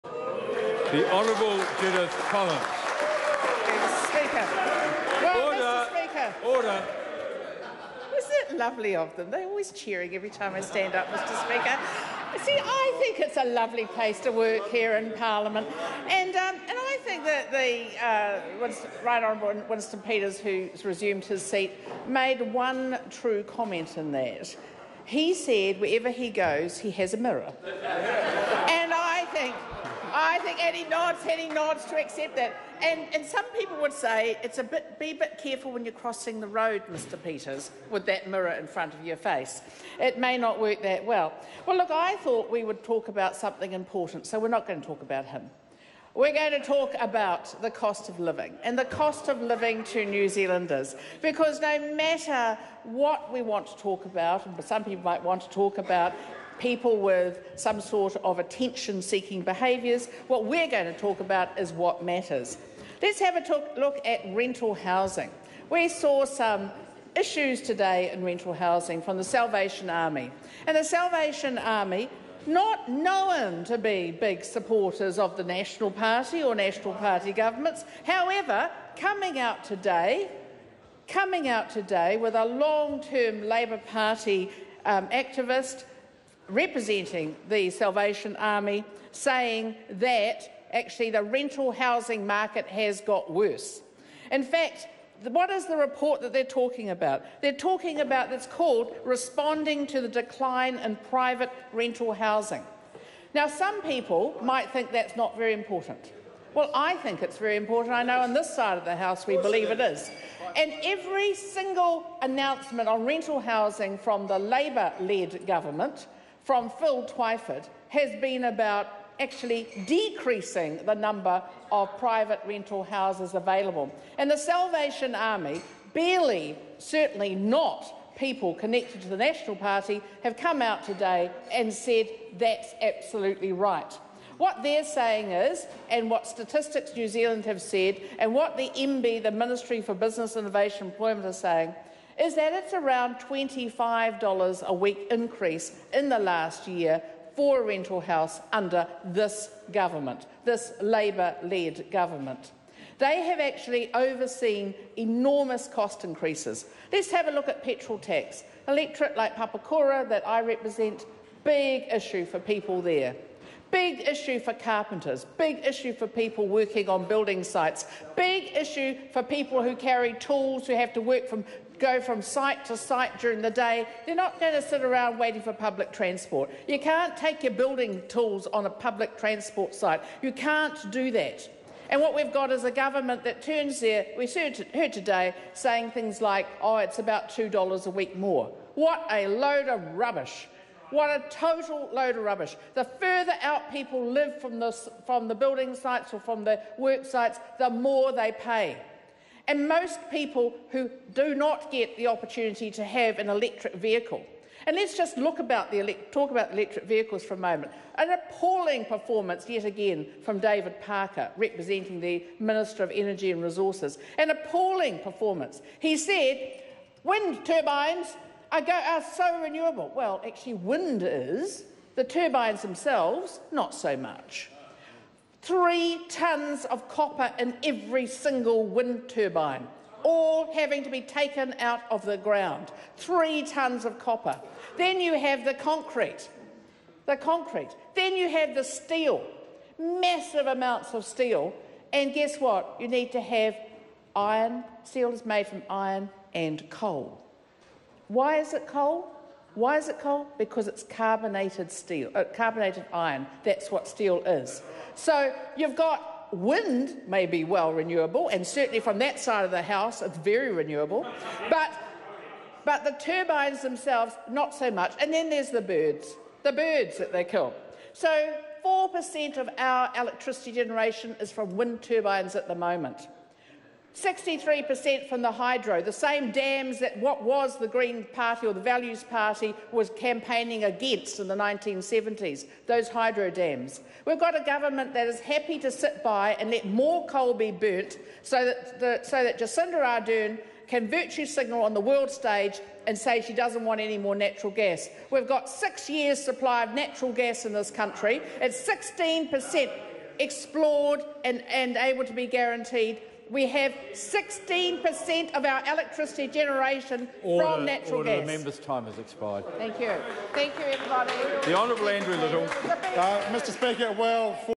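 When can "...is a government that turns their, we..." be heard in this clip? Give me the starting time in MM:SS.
03:02.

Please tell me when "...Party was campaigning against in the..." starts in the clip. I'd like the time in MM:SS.
04:39.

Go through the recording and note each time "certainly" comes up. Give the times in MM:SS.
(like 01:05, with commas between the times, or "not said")
02:06, 04:18.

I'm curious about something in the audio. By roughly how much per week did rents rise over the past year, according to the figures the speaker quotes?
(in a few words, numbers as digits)
$25.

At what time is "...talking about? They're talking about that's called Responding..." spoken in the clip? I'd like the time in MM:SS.
01:36.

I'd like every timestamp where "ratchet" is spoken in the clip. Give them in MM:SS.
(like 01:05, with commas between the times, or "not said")
not said.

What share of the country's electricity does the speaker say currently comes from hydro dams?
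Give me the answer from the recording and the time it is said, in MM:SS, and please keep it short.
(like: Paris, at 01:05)
63%, at 04:33.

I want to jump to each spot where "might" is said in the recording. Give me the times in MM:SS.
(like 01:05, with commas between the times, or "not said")
00:55, 01:44.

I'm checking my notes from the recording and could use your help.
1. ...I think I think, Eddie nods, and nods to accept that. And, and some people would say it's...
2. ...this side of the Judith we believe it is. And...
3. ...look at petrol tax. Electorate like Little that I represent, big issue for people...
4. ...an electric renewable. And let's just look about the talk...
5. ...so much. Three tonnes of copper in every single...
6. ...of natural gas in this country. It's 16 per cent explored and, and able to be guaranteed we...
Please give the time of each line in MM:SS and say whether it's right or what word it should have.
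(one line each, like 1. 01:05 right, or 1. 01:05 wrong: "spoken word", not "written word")
1. 00:28 right
2. 01:48 wrong: "House", not "Judith"
3. 02:37 wrong: "Papakura", not "Little"
4. 03:23 wrong: "vehicle", not "renewable"
5. 03:43 right
6. 04:56 right.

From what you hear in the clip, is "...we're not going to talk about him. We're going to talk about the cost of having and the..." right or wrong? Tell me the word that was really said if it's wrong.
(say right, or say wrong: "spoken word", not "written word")
wrong: "living", not "having".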